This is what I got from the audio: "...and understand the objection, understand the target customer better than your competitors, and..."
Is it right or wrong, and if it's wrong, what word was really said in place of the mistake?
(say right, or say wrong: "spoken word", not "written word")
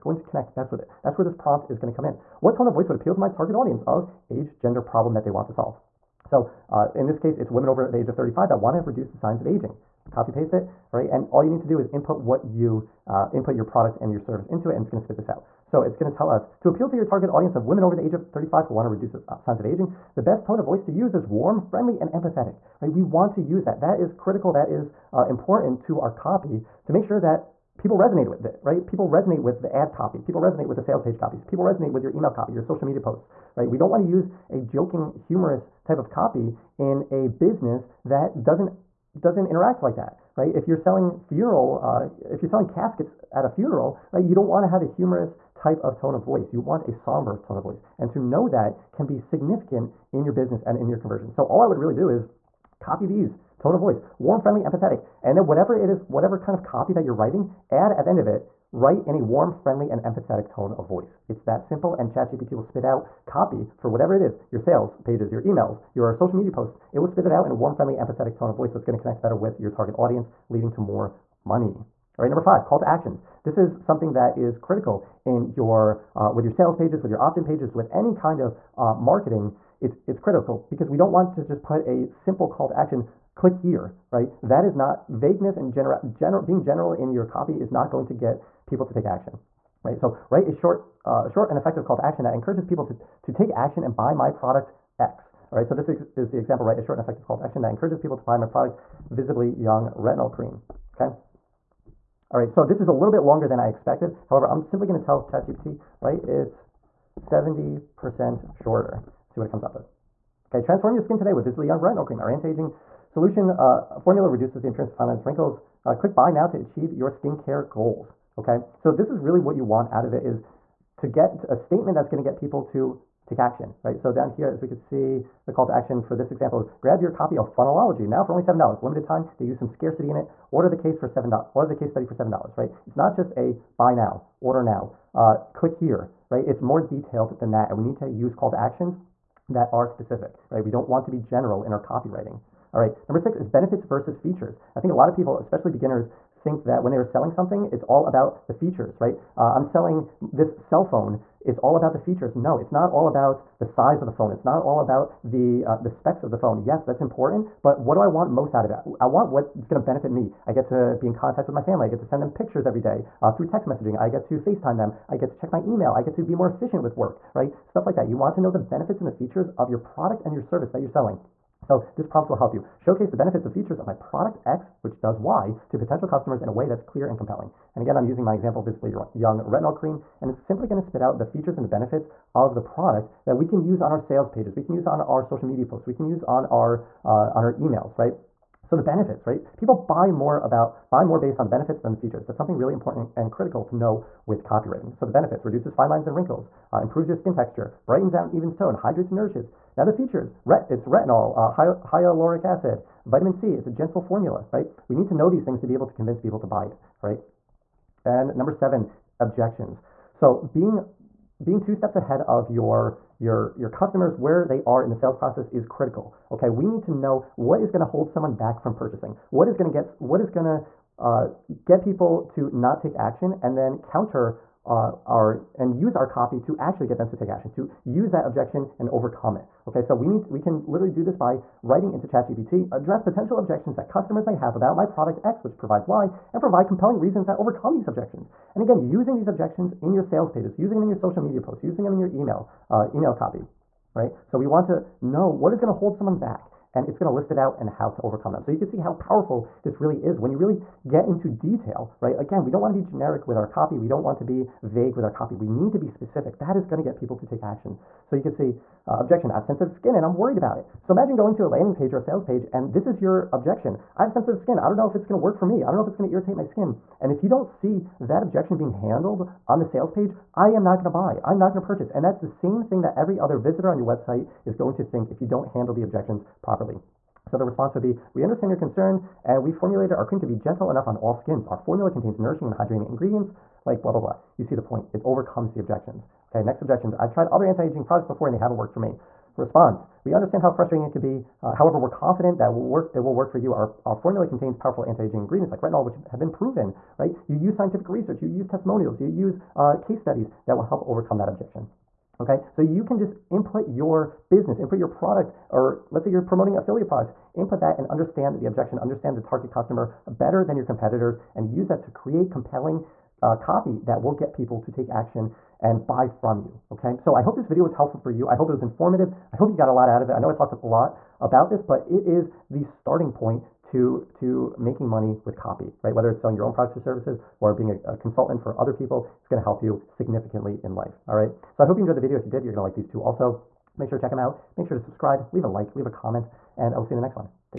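right.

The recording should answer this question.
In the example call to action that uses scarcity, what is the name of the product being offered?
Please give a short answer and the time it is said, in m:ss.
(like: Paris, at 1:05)
Funnelology, at 2:07.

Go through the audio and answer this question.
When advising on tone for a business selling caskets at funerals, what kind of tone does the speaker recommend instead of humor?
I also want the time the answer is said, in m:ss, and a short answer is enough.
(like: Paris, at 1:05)
Somber, at 0:46.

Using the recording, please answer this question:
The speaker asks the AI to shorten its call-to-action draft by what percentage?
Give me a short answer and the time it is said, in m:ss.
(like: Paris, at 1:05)
70%, at 1:47.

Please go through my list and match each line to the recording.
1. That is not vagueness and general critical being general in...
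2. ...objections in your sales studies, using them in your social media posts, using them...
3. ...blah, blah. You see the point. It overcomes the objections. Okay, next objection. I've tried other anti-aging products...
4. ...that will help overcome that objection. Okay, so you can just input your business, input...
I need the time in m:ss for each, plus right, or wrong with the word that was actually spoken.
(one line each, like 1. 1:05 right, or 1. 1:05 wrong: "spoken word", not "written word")
1. 1:24 wrong: "general", not "critical"
2. 3:59 wrong: "pages", not "studies"
3. 4:43 right
4. 5:00 right.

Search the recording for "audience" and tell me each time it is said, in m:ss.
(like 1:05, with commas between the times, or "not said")
0:03, 0:17, 1:09.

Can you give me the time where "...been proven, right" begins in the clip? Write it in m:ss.
4:56.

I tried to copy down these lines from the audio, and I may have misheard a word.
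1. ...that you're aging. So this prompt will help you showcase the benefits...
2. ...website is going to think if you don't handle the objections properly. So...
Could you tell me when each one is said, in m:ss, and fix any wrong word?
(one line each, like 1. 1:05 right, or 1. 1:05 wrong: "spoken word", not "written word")
1. 2:50 wrong: "selling", not "aging"
2. 4:33 right.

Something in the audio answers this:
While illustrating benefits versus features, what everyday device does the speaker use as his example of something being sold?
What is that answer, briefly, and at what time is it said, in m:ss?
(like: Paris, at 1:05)
Cell phone, at 2:30.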